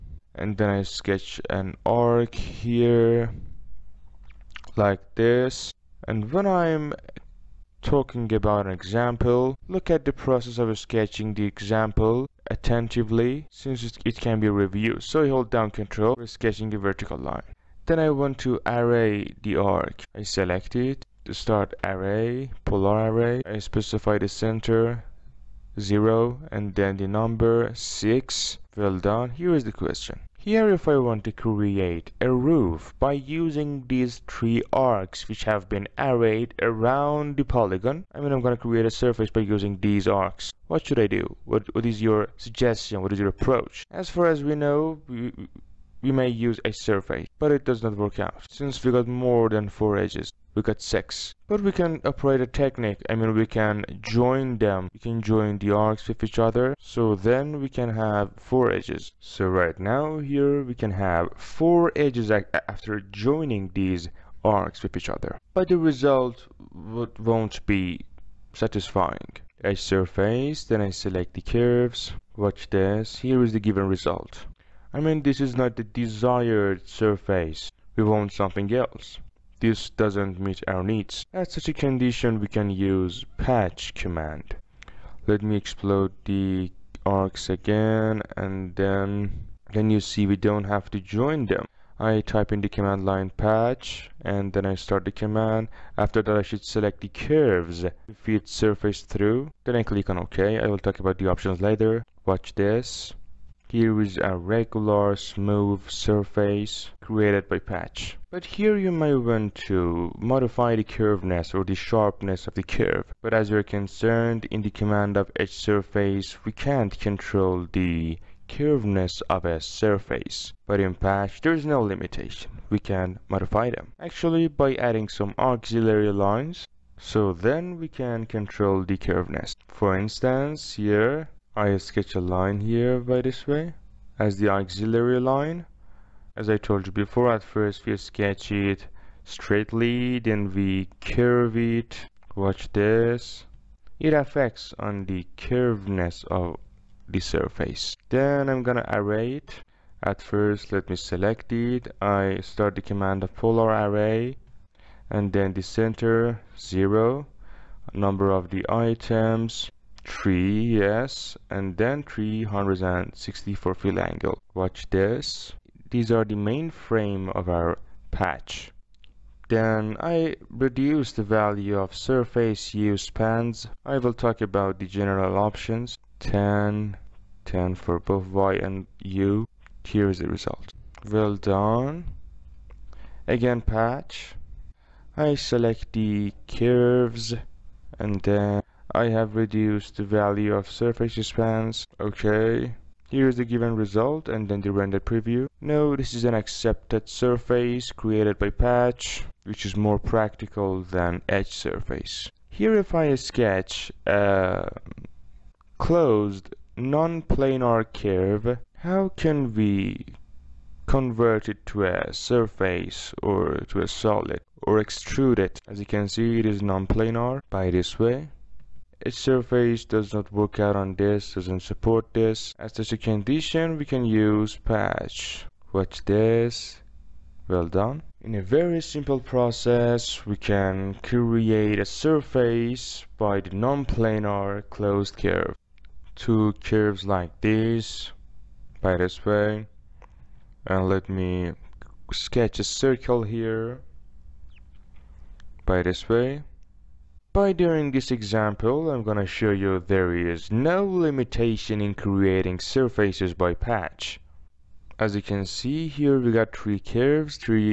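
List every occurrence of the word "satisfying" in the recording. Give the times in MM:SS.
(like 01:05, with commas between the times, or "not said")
01:08.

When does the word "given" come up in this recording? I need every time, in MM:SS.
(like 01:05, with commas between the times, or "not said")
01:13, 03:13.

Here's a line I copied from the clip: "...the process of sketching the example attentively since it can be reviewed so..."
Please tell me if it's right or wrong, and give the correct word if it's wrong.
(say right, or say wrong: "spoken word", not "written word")
right.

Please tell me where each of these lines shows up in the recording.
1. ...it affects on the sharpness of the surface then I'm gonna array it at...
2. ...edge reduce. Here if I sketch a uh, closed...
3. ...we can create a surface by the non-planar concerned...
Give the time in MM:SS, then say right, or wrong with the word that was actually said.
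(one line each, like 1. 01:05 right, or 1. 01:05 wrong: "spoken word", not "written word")
1. 02:24 wrong: "curviness", not "sharpness"
2. 03:21 wrong: "surface", not "reduce"
3. 03:50 wrong: "closed", not "concerned".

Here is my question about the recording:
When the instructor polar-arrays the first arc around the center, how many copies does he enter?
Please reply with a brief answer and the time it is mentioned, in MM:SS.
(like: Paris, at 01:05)
6, at 00:26.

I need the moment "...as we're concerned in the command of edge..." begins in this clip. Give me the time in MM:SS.
01:53.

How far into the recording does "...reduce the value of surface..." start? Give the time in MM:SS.
02:50.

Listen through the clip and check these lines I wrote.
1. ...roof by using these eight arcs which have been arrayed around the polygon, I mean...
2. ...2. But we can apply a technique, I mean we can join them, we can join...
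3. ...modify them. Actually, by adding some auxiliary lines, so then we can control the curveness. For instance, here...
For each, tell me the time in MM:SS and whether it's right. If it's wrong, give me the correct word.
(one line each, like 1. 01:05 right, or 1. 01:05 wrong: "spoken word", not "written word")
1. 00:32 wrong: "three", not "eight"
2. 00:50 wrong: "6", not "2"
3. 02:03 right.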